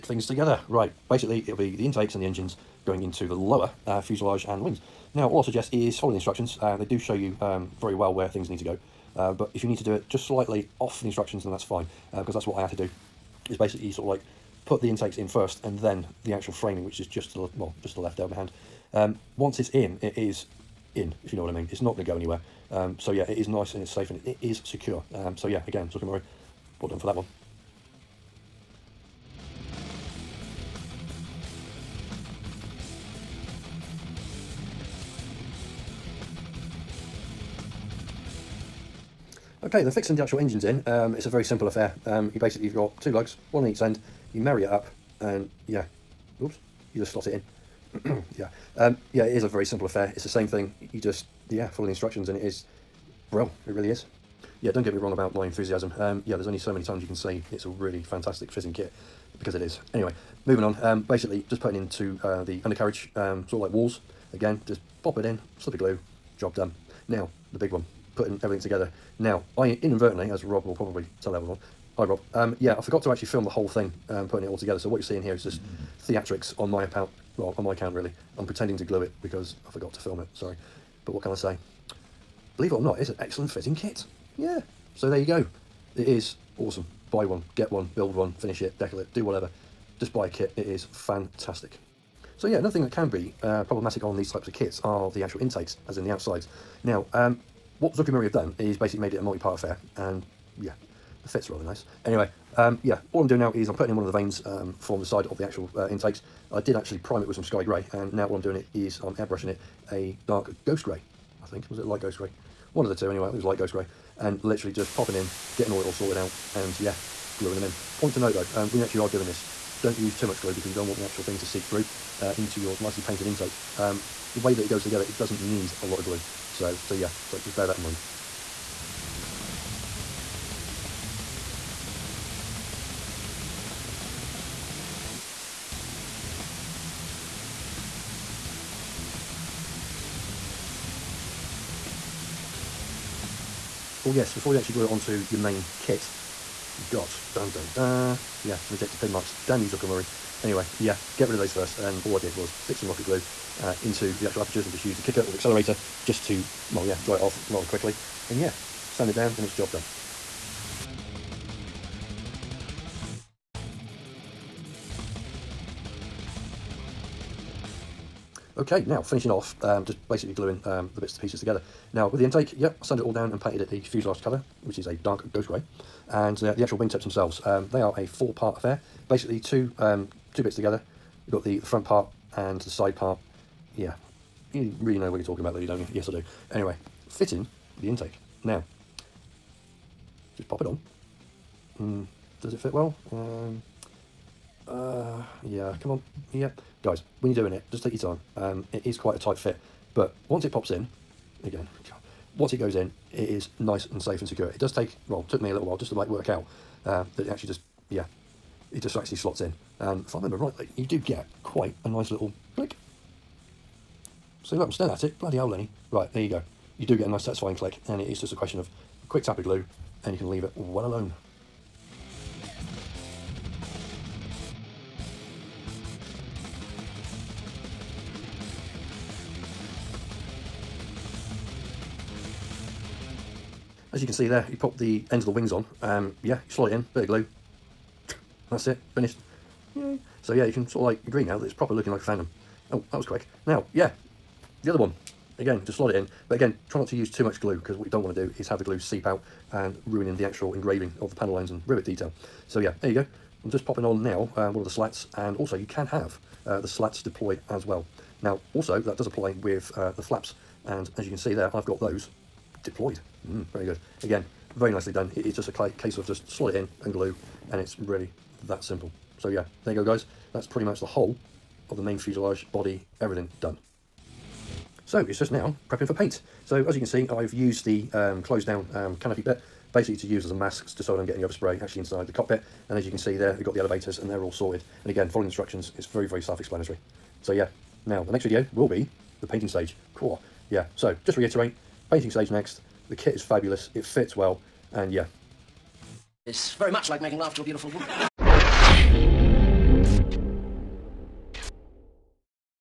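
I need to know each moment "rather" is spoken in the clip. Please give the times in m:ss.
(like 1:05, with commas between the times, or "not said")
1:41, 2:37.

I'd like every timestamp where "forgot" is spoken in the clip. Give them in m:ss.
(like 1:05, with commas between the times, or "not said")
1:12, 1:19.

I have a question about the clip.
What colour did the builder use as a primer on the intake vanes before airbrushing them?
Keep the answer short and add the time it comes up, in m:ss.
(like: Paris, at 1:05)
Sky grey, at 1:47.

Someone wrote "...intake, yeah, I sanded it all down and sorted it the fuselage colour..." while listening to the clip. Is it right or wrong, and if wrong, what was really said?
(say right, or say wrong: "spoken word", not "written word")
wrong: "painted", not "sorted".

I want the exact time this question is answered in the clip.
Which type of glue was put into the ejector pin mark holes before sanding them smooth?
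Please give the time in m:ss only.
2:32.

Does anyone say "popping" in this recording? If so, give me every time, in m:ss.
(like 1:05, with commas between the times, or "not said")
1:54, 4:13.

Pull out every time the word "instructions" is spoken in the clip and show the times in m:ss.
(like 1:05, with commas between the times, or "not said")
0:06, 0:11, 0:51, 4:45.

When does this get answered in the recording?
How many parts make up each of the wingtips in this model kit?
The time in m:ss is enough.
2:58.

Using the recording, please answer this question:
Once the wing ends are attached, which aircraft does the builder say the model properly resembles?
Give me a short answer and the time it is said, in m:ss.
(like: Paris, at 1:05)
Phantom, at 4:02.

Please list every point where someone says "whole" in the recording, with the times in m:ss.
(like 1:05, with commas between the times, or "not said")
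1:13, 4:30.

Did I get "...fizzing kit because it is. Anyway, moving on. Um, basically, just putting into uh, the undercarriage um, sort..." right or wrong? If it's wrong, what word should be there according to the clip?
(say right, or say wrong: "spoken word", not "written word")
right.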